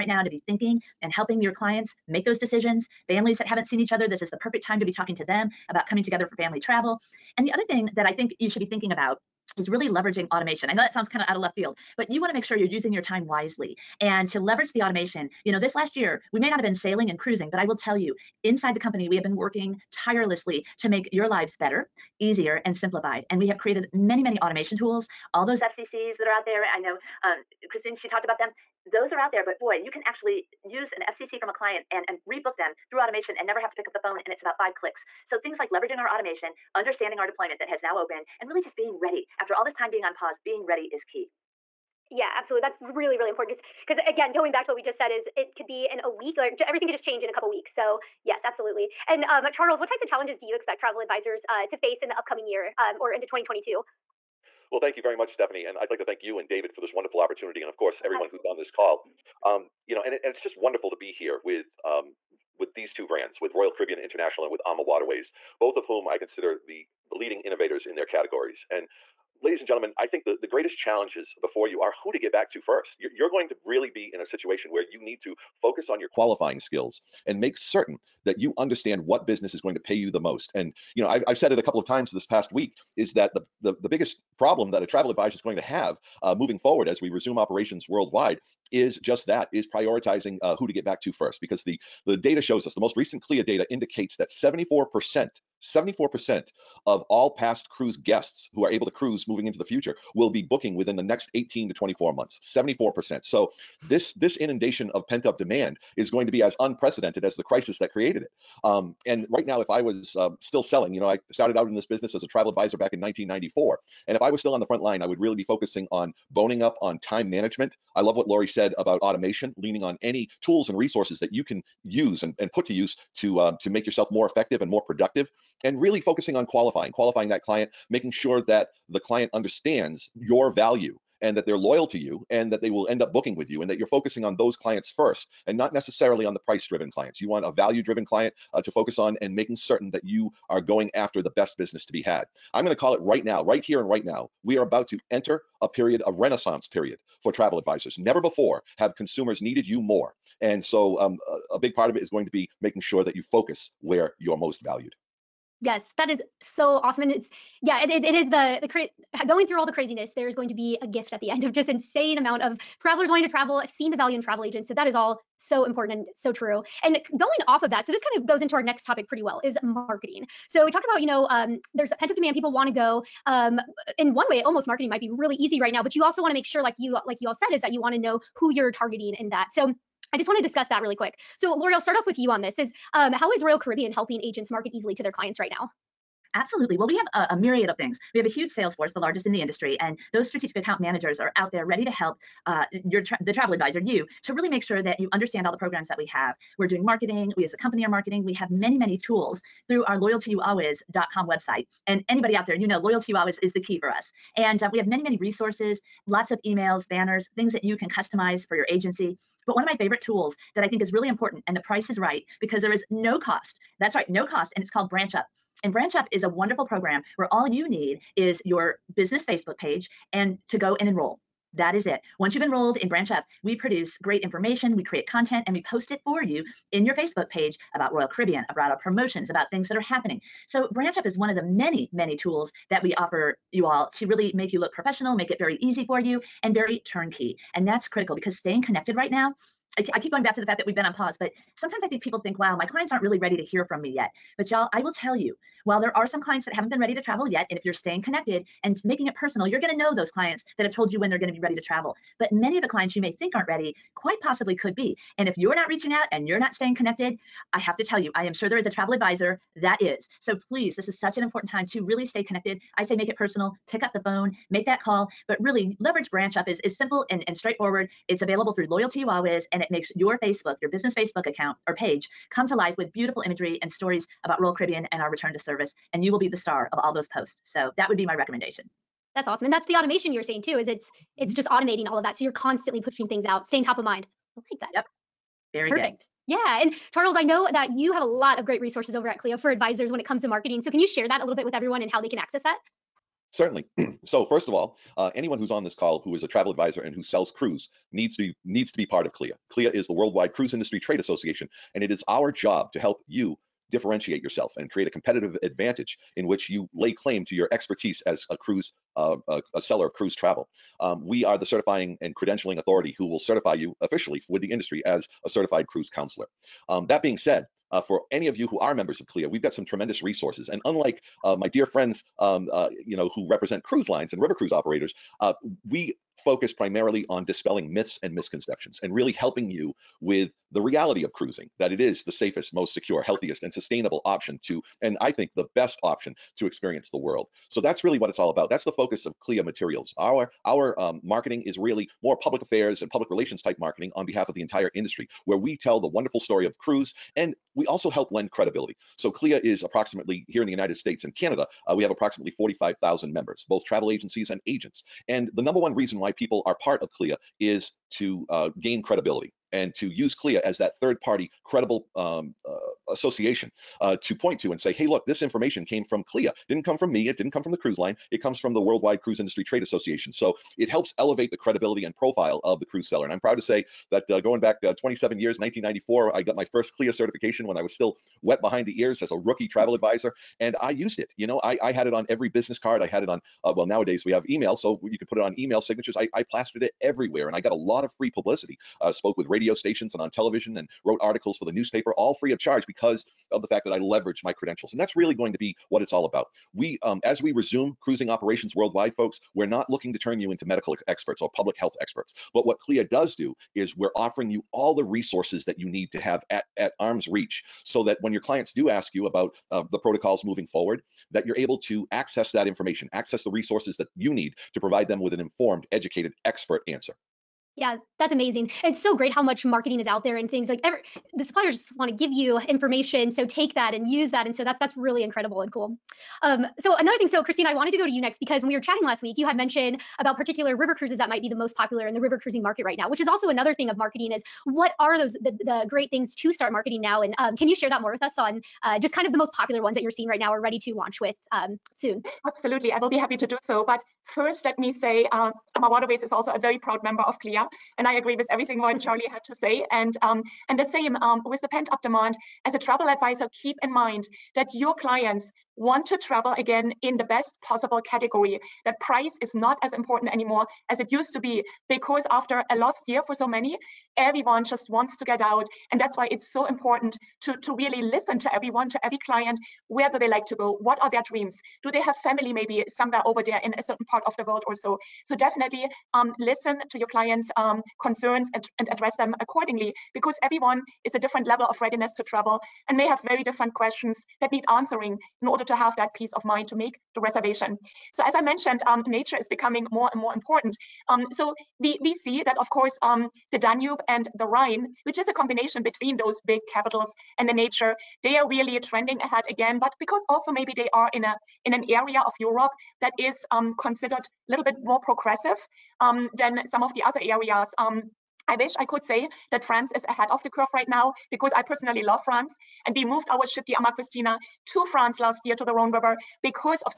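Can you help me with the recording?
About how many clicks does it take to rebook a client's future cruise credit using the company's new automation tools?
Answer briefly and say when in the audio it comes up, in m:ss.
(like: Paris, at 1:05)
5, at 0:34.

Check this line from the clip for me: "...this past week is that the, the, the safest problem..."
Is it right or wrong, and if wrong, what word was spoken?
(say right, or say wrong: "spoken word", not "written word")
wrong: "biggest", not "safest".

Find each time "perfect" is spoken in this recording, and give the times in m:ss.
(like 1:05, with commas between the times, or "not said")
0:04, 4:45.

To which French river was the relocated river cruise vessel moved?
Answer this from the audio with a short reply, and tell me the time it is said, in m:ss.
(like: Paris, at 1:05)
Rhone, at 8:35.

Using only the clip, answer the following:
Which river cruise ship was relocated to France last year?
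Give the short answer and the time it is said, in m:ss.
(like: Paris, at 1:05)
Ama Kristina, at 8:33.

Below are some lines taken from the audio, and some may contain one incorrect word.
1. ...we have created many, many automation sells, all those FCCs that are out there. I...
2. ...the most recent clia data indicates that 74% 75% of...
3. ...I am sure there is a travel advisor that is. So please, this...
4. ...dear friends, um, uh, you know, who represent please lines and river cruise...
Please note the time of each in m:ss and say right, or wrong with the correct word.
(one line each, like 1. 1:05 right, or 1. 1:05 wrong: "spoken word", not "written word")
1. 0:23 wrong: "tools", not "sells"
2. 1:32 wrong: "74", not "75"
3. 4:18 right
4. 5:21 wrong: "cruise", not "please".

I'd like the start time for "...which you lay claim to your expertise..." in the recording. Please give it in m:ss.
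5:06.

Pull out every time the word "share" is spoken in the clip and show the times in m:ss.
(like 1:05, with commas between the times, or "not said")
4:50, 7:17.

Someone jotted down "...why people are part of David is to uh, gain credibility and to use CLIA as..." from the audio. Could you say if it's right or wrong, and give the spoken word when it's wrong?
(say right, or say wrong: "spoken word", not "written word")
wrong: "CLIA", not "David".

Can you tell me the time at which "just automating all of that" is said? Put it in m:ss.
4:41.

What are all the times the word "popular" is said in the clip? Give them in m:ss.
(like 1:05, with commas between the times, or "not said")
7:11, 7:19.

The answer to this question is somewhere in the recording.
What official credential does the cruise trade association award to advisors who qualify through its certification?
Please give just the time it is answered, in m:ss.
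5:15.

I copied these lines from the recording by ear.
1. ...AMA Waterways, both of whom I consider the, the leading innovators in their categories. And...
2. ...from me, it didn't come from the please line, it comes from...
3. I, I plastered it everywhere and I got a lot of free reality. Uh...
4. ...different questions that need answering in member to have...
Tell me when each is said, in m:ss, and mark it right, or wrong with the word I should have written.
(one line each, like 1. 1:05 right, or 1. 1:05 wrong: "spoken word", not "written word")
1. 1:04 right
2. 6:06 wrong: "cruise", not "please"
3. 6:25 wrong: "publicity", not "reality"
4. 8:03 wrong: "order", not "member".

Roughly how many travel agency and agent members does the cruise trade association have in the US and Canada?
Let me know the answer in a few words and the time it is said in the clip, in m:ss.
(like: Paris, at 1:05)
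45,000, at 5:52.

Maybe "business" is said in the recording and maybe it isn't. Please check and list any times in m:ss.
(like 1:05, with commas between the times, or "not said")
1:19, 1:51, 2:21, 3:38, 4:30, 6:22.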